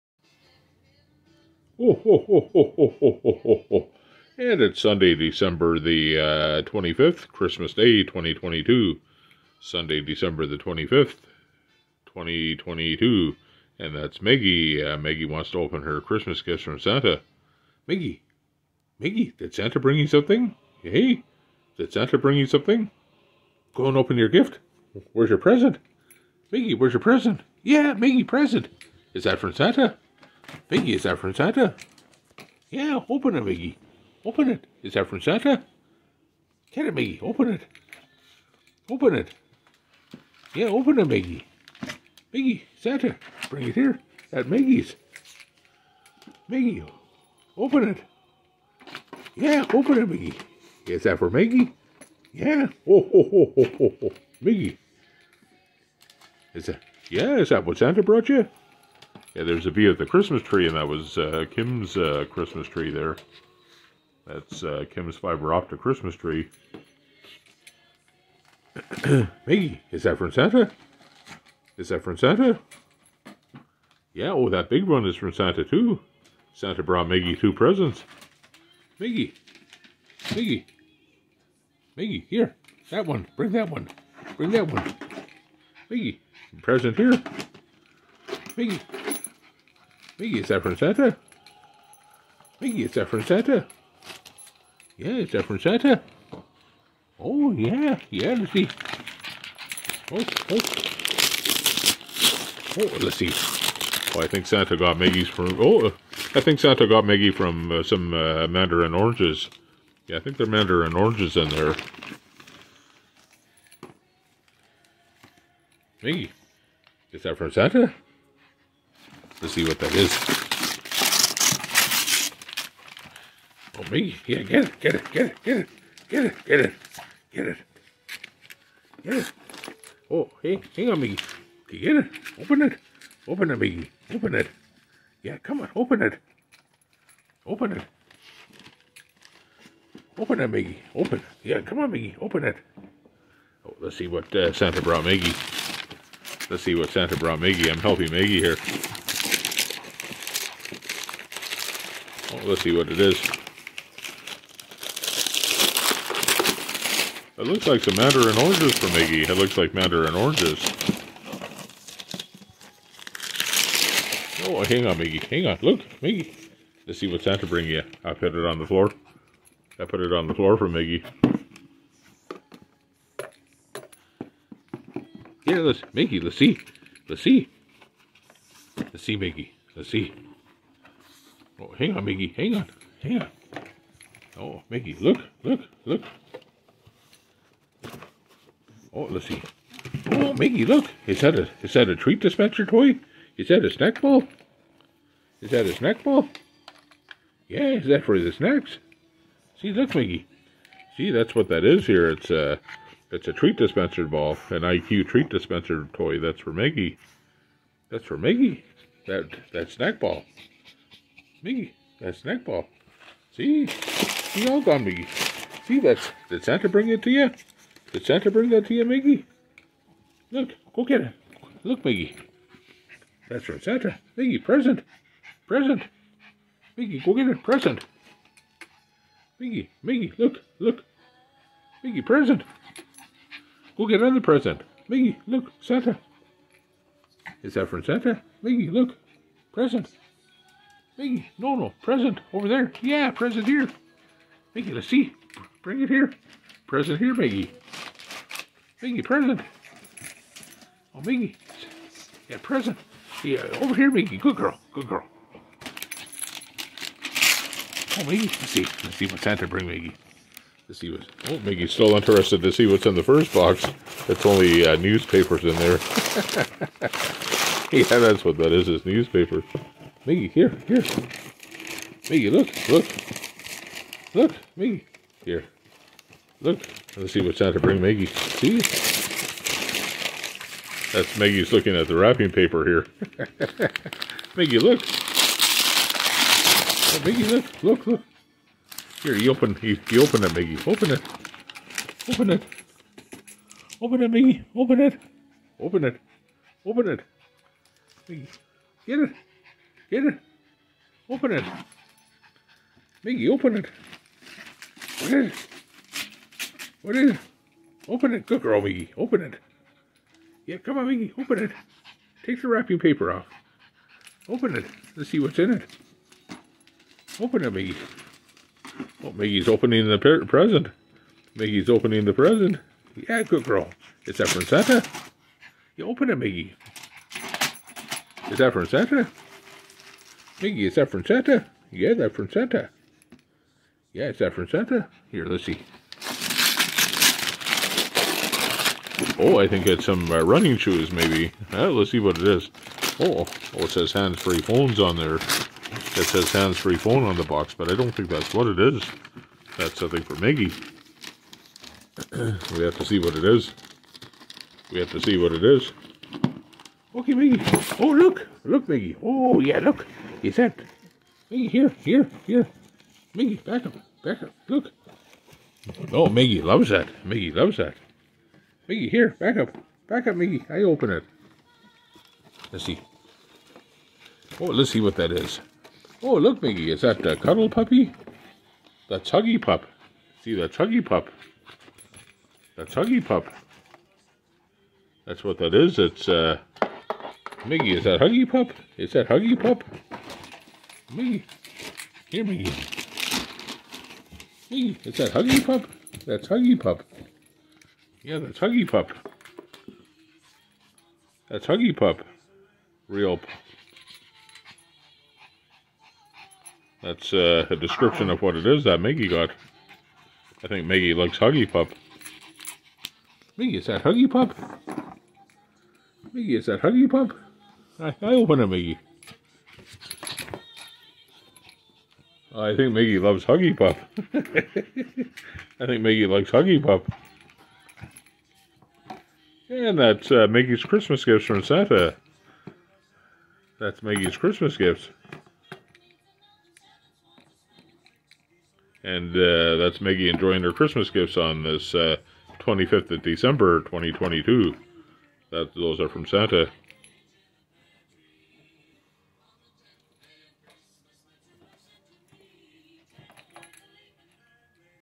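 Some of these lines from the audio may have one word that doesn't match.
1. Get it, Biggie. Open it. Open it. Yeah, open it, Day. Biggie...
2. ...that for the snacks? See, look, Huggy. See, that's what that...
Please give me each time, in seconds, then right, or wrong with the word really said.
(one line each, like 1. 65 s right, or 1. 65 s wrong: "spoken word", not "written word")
1. 36 s wrong: "Biggie", not "Day"
2. 197 s wrong: "Miggy", not "Huggy".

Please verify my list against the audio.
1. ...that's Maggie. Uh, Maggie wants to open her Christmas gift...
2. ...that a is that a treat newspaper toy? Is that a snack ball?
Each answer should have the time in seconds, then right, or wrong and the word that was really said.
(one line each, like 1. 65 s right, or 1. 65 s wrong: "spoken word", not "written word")
1. 13 s right
2. 191 s wrong: "dispenser", not "newspaper".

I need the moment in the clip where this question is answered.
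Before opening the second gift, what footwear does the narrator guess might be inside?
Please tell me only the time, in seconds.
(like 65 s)
340 s.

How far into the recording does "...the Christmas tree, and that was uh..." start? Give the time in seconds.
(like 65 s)
59 s.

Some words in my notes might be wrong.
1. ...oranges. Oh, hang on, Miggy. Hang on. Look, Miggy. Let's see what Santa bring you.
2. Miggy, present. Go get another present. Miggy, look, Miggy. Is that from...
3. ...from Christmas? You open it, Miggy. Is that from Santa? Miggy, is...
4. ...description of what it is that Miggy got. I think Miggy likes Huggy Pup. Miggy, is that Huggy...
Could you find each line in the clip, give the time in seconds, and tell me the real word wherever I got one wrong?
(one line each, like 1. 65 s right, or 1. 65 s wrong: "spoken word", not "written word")
1. 160 s right
2. 231 s wrong: "Santa", not "Miggy"
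3. 324 s wrong: "Santa", not "Christmas"
4. 407 s right.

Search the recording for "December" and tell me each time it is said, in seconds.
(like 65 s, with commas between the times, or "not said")
5 s, 10 s, 443 s.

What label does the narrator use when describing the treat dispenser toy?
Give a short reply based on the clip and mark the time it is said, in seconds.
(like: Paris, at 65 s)
IQ, at 204 s.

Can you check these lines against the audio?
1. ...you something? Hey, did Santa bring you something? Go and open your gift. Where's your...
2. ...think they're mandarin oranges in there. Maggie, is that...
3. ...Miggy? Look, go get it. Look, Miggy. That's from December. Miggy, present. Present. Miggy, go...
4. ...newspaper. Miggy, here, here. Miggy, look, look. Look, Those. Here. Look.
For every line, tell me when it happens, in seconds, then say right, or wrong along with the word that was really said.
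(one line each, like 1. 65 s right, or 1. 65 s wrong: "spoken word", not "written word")
1. 19 s right
2. 110 s right
3. 218 s wrong: "Santa", not "December"
4. 268 s wrong: "Miggy", not "Those".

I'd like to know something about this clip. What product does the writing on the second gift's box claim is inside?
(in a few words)
hands-free phones.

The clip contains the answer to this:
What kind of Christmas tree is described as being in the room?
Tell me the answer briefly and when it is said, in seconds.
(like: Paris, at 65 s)
fiber optic, at 65 s.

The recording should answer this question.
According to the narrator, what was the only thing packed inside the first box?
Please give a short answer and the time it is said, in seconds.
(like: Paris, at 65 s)
newspapers, at 264 s.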